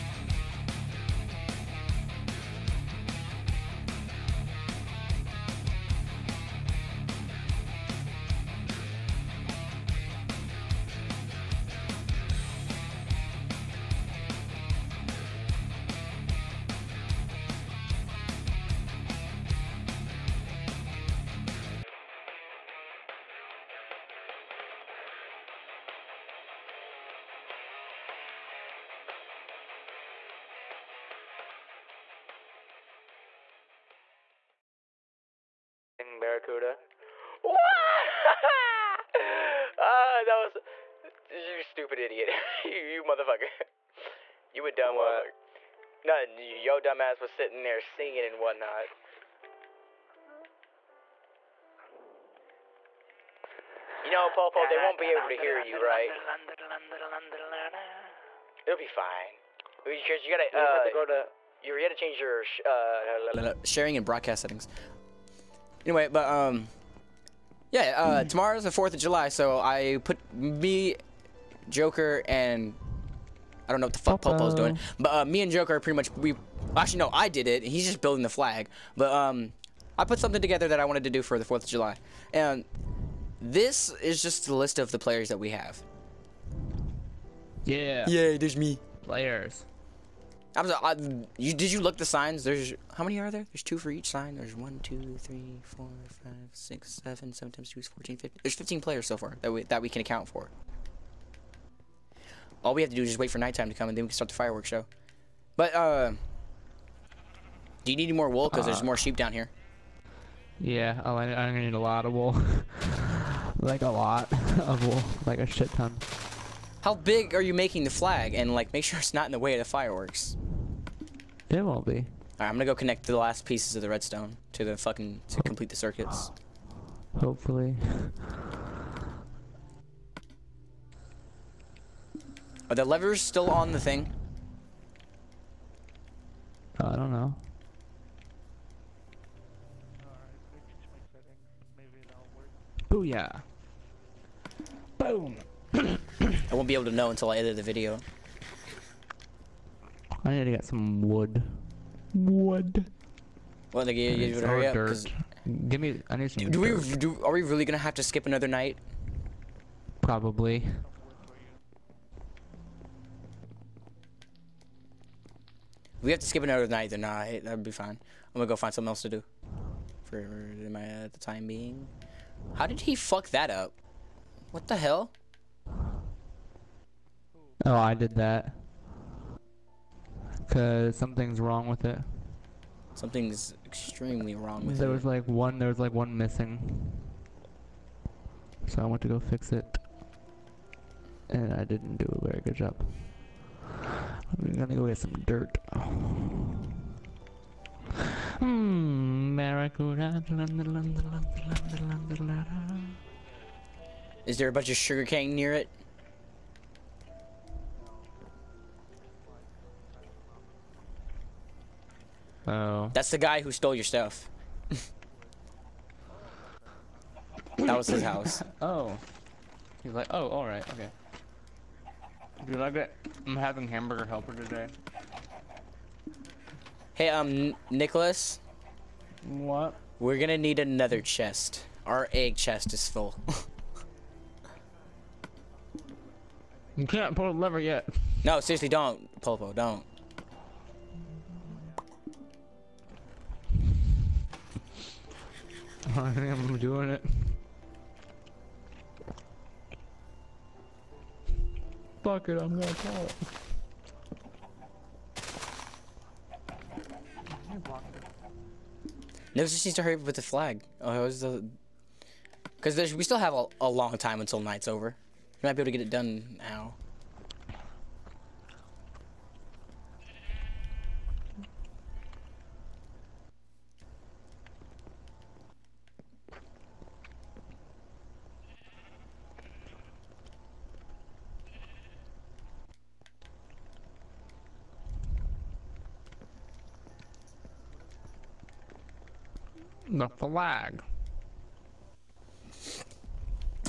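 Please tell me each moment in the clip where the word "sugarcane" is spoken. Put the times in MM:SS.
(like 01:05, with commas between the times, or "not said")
03:24.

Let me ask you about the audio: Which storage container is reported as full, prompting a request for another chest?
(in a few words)
egg chest.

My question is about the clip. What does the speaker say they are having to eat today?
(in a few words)
Hamburger Helper.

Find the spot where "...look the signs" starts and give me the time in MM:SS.
01:31.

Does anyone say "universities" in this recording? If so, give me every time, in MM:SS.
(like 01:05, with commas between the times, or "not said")
not said.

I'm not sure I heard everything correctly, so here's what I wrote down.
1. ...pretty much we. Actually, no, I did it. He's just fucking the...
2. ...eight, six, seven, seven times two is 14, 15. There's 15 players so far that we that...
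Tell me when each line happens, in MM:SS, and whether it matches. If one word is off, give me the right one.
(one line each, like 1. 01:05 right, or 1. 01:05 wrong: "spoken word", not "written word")
1. 01:15 wrong: "building", not "fucking"
2. 01:36 wrong: "five", not "eight".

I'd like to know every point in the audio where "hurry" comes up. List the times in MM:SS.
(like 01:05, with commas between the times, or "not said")
02:34, 04:19.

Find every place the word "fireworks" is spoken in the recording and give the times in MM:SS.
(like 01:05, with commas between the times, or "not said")
01:44, 01:59.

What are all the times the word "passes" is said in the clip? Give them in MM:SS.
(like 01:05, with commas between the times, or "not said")
not said.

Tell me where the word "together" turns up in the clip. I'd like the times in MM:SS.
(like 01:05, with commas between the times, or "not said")
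01:20.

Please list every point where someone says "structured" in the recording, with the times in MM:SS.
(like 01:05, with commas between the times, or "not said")
not said.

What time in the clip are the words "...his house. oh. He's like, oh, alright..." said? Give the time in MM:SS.
03:37.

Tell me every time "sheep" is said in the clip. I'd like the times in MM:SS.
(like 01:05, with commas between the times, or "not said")
01:48.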